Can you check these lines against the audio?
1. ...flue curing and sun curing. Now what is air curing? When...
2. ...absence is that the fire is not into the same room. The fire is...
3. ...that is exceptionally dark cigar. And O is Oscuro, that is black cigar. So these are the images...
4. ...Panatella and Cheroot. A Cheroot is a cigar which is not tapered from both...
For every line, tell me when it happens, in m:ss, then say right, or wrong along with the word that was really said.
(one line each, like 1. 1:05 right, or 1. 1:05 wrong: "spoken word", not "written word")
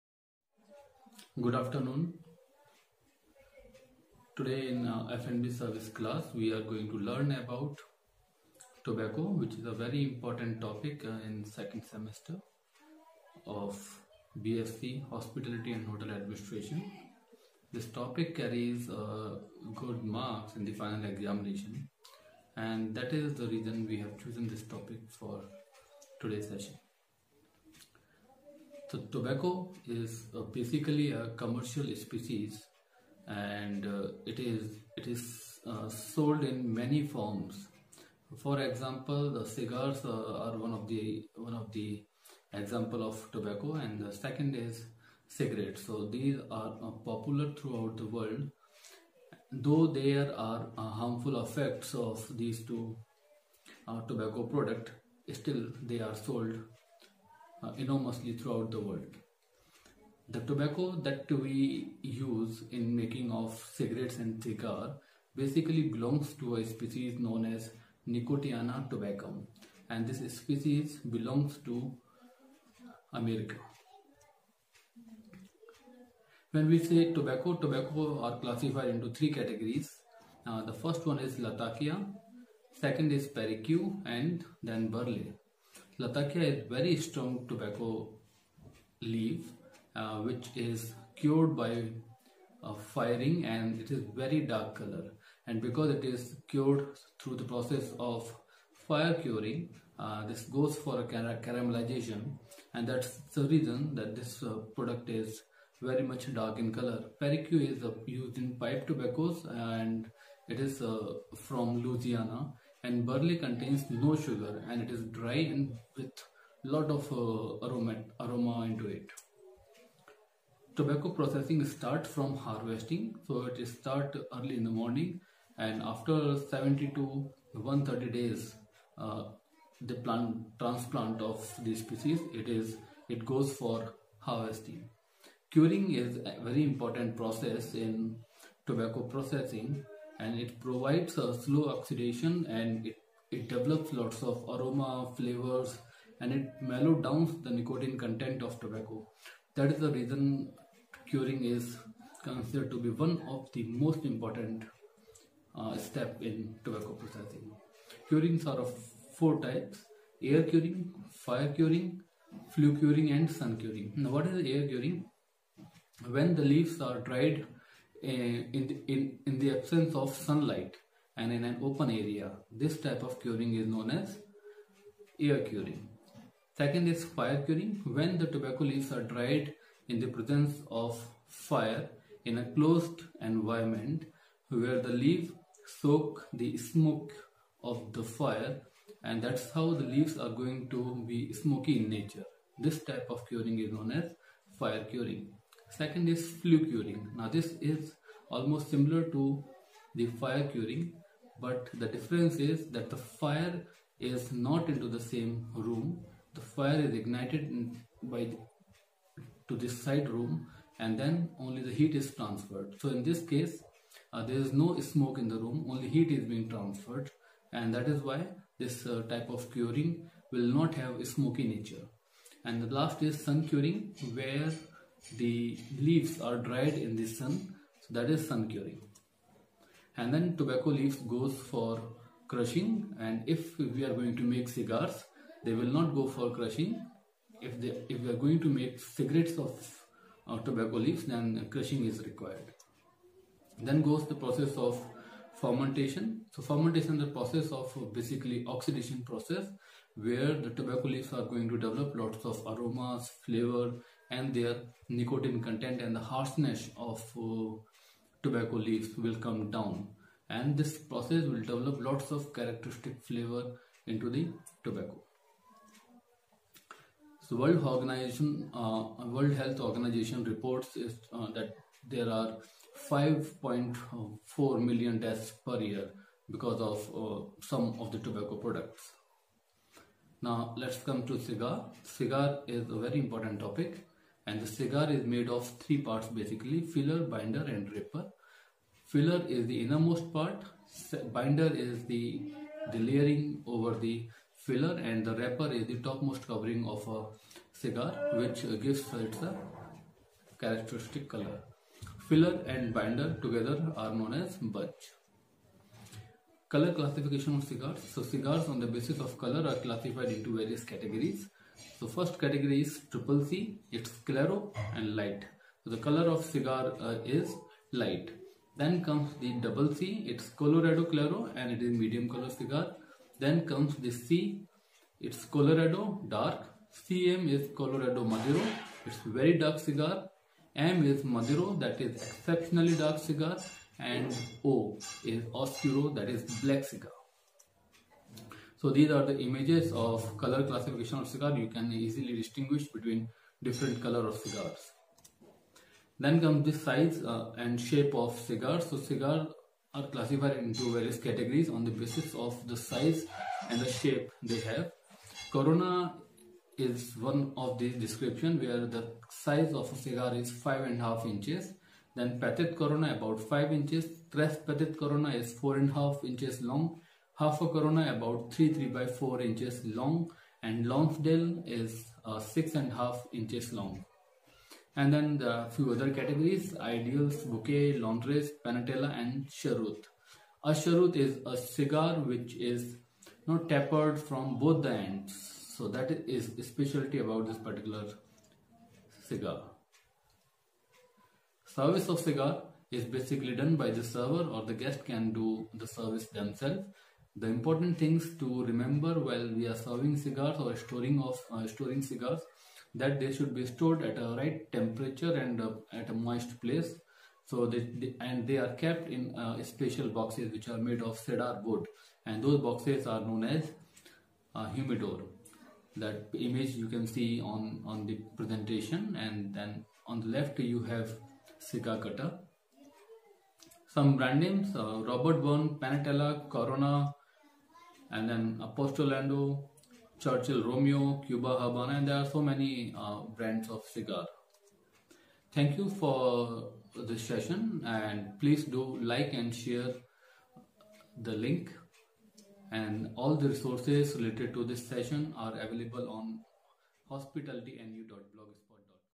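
1. 2:42 right
2. 3:21 wrong: "difference", not "absence"
3. 5:31 right
4. 6:18 right.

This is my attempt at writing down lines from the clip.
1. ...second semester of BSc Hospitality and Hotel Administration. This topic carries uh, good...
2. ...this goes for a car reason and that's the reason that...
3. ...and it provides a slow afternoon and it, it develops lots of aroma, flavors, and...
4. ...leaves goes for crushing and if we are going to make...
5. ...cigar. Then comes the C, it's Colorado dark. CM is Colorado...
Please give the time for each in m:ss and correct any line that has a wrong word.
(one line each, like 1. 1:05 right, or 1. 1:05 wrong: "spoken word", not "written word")
1. 0:11 right
2. 1:40 wrong: "caramelization", not "reason"
3. 2:20 wrong: "oxidation", not "afternoon"
4. 3:50 right
5. 5:22 right.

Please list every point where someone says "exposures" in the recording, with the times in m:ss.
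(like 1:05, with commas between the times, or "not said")
not said.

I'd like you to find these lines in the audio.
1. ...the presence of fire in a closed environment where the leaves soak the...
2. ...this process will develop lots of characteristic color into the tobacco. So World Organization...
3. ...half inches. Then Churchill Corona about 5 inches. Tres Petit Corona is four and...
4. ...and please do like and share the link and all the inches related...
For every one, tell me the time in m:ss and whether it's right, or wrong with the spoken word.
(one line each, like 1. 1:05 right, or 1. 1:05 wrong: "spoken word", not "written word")
1. 2:59 right
2. 4:20 wrong: "flavor", not "color"
3. 6:00 wrong: "Petit", not "Churchill"
4. 7:17 wrong: "resources", not "inches".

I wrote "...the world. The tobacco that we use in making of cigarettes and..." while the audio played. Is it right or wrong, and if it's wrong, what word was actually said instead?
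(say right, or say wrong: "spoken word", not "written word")
right.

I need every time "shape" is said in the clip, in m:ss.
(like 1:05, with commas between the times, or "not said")
5:47, 5:53.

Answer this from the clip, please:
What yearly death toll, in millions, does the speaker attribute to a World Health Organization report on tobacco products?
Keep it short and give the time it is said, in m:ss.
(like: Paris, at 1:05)
5.4 million, at 4:32.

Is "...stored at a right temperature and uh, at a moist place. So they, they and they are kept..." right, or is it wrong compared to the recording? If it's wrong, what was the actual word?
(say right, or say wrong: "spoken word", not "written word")
right.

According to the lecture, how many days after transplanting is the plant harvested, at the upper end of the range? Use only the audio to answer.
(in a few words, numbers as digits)
130.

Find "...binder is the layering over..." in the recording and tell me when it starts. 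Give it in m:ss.
4:51.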